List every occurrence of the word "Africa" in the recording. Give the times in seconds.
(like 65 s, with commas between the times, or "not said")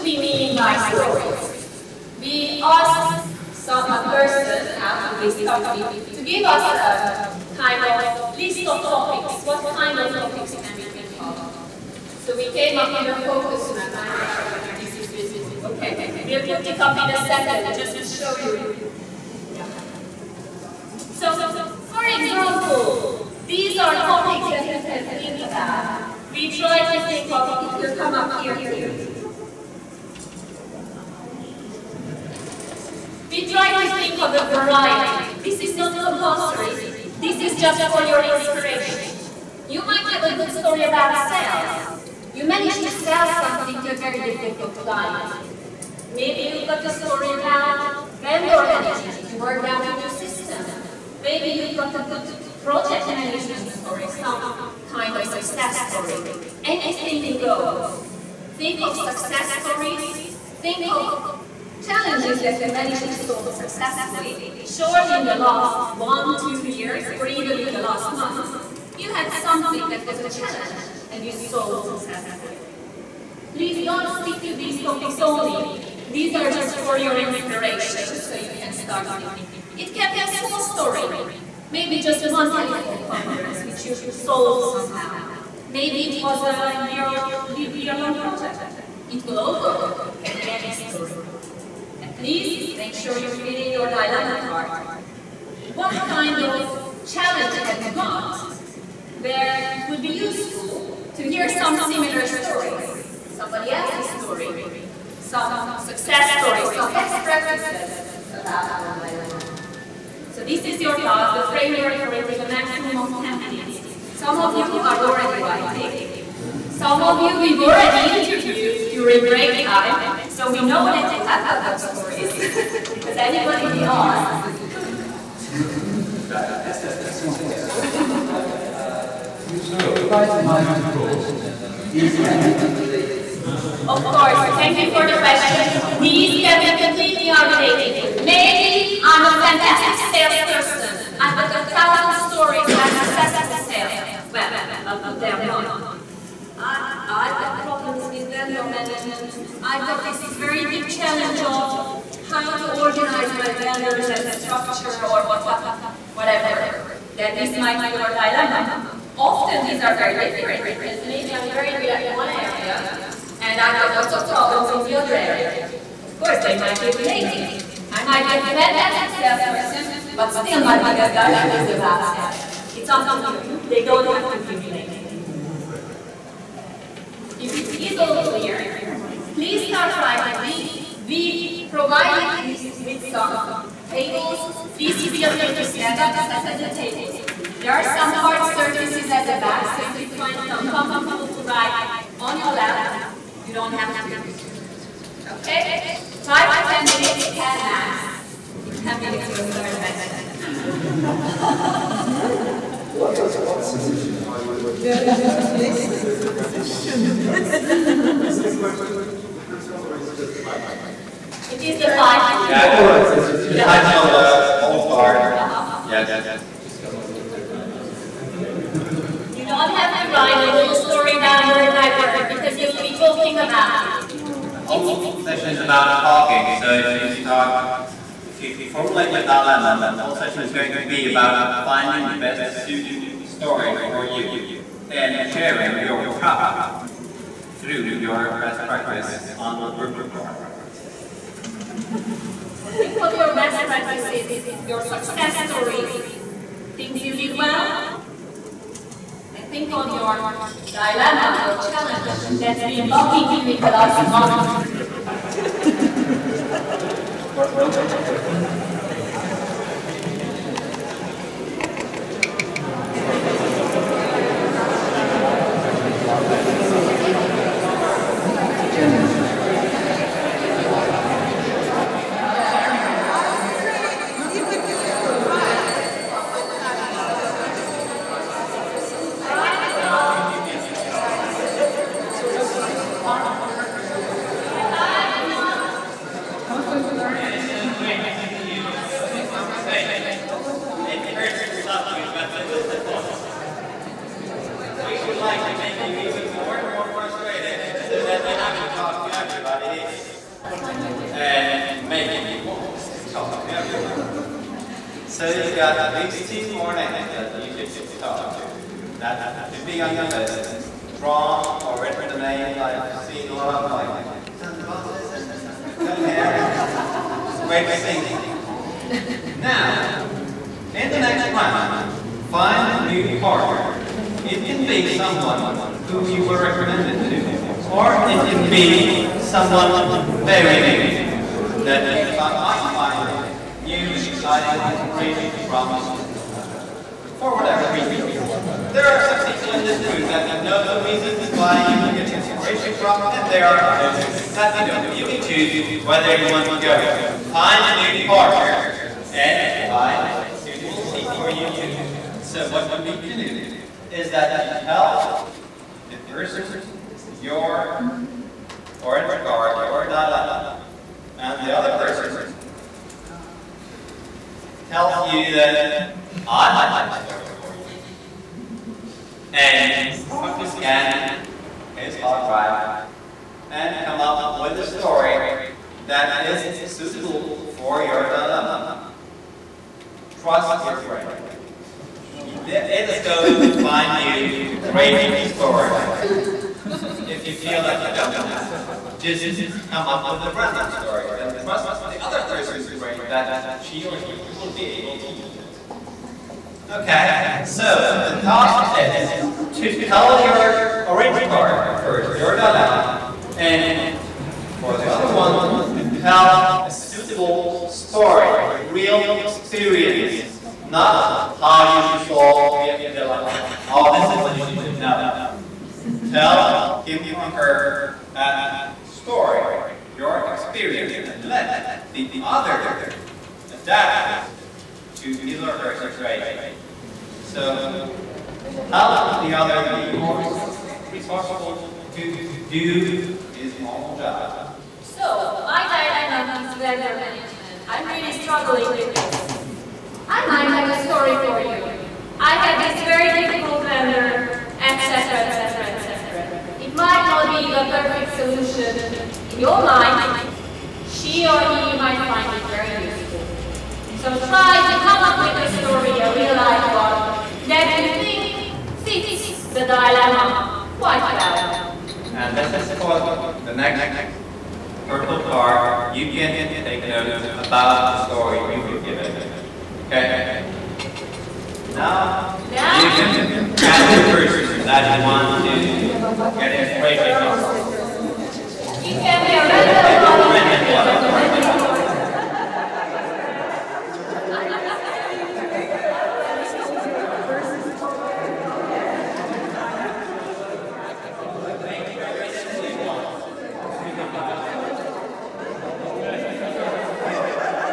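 not said.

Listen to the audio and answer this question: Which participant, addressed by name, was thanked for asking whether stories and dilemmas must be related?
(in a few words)
Eszter.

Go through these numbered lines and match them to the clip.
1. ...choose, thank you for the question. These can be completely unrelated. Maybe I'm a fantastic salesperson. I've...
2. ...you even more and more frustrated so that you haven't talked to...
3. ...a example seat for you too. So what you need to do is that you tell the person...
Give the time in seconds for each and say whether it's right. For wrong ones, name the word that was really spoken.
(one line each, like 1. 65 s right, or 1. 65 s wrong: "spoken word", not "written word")
1. 134 s wrong: "course", not "choose"
2. 295 s right
3. 350 s wrong: "suitable", not "example".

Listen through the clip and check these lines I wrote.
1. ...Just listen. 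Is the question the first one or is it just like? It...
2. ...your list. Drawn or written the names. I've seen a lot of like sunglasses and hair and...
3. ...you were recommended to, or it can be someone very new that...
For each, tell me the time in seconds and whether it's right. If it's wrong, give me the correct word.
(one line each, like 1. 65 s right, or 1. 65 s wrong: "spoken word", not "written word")
1. 204 s right
2. 309 s right
3. 326 s right.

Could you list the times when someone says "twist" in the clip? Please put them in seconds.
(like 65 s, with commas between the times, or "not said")
not said.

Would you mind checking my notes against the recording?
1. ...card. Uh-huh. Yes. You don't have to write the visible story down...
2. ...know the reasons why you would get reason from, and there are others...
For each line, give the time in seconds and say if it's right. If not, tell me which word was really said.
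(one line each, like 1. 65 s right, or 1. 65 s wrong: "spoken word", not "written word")
1. 214 s wrong: "whole", not "visible"
2. 340 s wrong: "inspiration", not "reason".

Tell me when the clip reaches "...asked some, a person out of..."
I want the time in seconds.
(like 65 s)
2 s.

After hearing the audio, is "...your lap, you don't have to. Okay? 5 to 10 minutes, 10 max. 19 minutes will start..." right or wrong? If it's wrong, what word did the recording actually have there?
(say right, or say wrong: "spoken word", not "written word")
wrong: "10", not "19".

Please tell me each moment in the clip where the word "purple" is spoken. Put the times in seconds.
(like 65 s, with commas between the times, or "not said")
239 s, 464 s.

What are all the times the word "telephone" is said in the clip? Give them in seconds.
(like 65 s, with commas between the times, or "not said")
82 s.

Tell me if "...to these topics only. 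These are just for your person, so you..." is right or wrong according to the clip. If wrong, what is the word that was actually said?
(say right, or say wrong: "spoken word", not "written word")
wrong: "inspiration", not "person".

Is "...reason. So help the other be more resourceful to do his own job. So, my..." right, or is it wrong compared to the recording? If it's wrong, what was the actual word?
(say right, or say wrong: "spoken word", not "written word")
wrong: "situation", not "reason".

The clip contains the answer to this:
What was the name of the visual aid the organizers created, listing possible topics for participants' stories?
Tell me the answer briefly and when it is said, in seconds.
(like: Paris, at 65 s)
Focus map, at 13 s.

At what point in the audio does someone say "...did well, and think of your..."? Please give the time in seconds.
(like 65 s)
247 s.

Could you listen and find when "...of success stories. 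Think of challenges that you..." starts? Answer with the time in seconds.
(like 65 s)
58 s.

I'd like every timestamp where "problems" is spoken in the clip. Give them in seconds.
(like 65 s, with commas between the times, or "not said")
147 s, 164 s.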